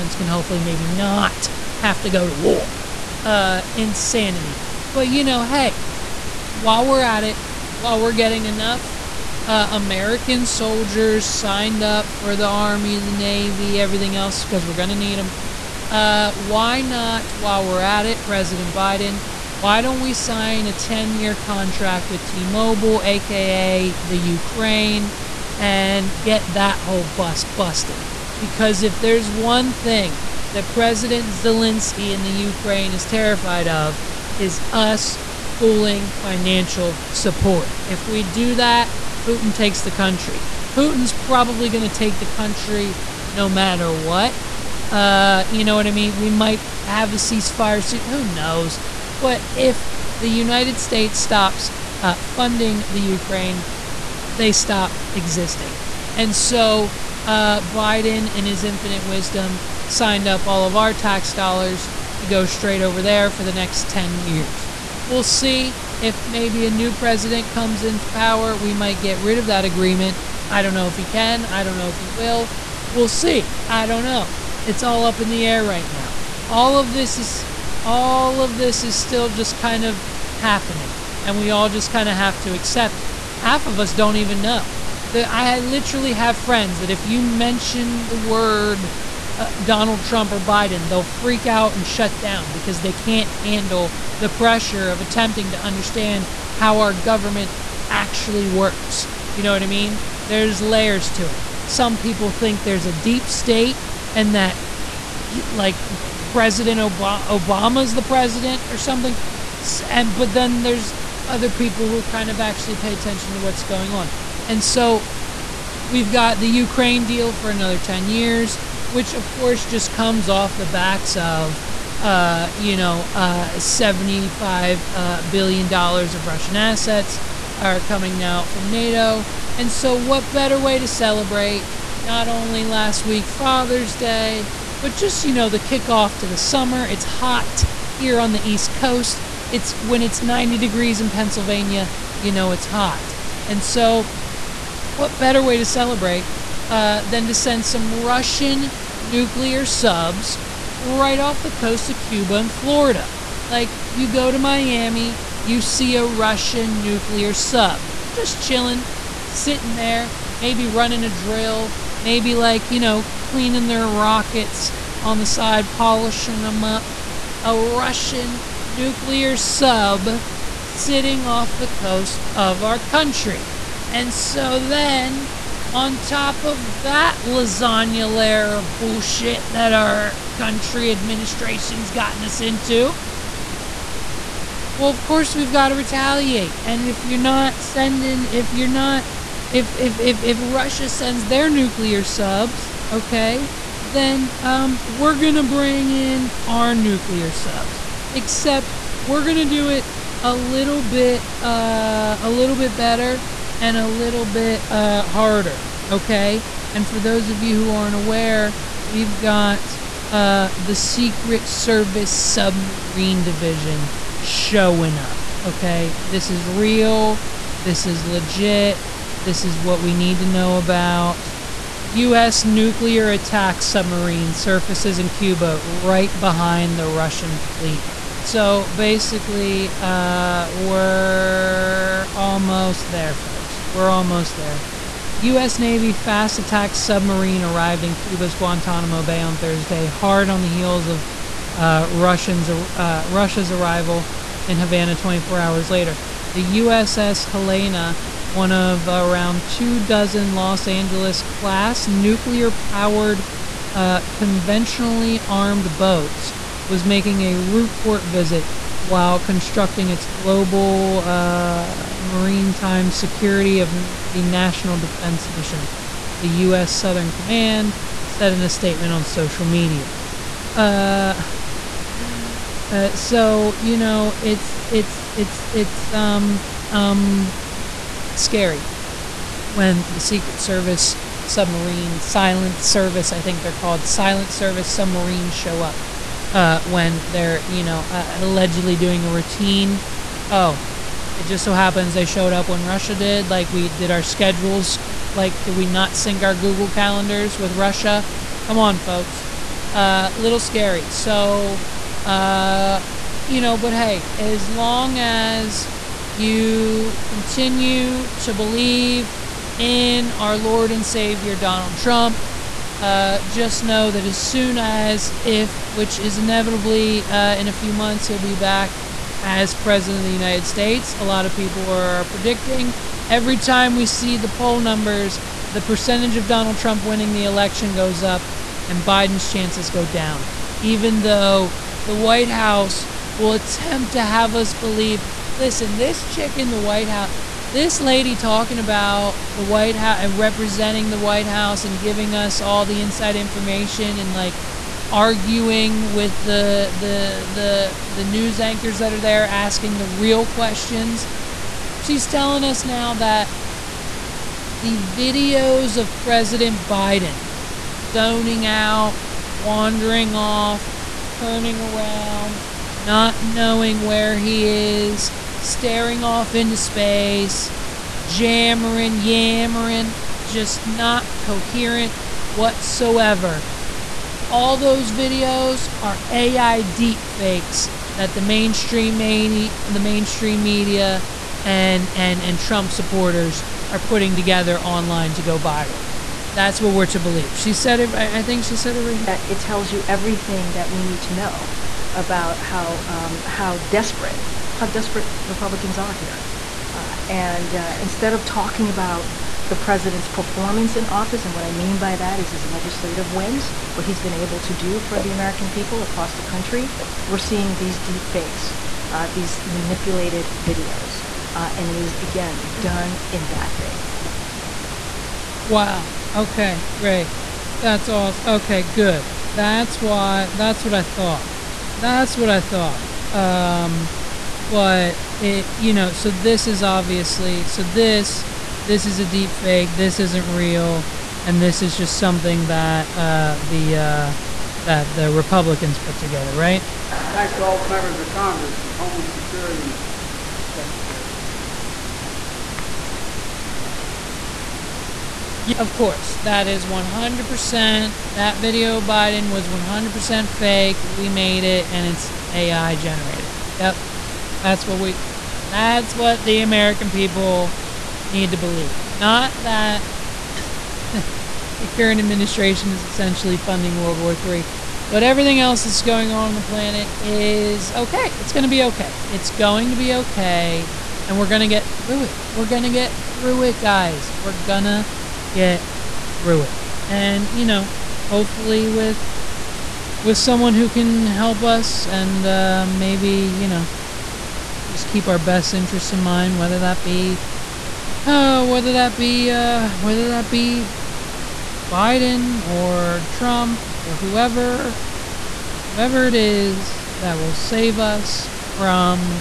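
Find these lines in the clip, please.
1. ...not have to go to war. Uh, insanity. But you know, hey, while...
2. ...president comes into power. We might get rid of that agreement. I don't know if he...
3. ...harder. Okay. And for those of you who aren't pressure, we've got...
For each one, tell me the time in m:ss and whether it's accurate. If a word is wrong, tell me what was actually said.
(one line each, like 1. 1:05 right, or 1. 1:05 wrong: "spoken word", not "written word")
1. 0:00 right
2. 1:06 right
3. 3:25 wrong: "aware", not "pressure".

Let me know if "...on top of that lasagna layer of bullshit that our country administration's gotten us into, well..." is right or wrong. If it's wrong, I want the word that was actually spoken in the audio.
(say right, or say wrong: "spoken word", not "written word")
right.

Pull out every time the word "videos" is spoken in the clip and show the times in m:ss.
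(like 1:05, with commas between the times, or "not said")
5:54, 6:14, 6:50, 7:28.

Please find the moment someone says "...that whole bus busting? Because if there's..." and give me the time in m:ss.
0:26.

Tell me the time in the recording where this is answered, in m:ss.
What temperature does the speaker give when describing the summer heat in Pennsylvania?
2:20.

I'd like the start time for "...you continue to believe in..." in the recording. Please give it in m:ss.
5:06.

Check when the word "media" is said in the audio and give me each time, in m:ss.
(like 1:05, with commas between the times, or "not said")
4:29, 6:20.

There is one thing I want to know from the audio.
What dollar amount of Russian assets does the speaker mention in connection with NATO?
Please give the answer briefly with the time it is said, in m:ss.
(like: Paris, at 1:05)
$75 billion, at 2:03.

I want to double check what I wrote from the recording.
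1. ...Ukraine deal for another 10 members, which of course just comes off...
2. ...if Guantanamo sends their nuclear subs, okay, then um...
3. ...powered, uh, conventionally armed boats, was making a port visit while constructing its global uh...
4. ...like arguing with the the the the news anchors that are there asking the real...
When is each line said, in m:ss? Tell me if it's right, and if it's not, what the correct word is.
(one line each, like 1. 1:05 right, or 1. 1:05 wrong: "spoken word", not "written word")
1. 1:56 wrong: "years", not "members"
2. 3:10 wrong: "Russia", not "Guantanamo"
3. 4:12 right
4. 5:44 right.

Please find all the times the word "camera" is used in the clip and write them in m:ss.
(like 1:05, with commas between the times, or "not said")
not said.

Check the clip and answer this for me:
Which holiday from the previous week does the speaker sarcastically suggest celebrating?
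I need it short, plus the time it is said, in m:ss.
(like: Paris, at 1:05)
Father's Day, at 2:13.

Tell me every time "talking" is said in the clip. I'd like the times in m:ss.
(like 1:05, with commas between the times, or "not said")
5:38, 6:38.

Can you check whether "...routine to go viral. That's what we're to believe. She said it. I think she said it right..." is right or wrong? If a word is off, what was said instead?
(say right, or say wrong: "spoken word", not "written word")
wrong: "online", not "routine".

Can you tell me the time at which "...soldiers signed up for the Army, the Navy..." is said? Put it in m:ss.
0:10.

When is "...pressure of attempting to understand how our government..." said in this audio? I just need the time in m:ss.
1:34.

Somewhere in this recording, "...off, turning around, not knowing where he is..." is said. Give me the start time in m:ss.
6:00.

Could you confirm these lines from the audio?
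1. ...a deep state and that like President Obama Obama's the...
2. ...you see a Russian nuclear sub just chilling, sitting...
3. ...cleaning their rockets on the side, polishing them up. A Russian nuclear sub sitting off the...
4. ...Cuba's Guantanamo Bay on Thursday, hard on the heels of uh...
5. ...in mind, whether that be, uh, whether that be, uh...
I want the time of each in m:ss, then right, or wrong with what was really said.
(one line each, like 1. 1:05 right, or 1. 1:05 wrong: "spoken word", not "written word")
1. 1:42 right
2. 2:35 right
3. 2:43 right
4. 3:57 right
5. 8:05 right.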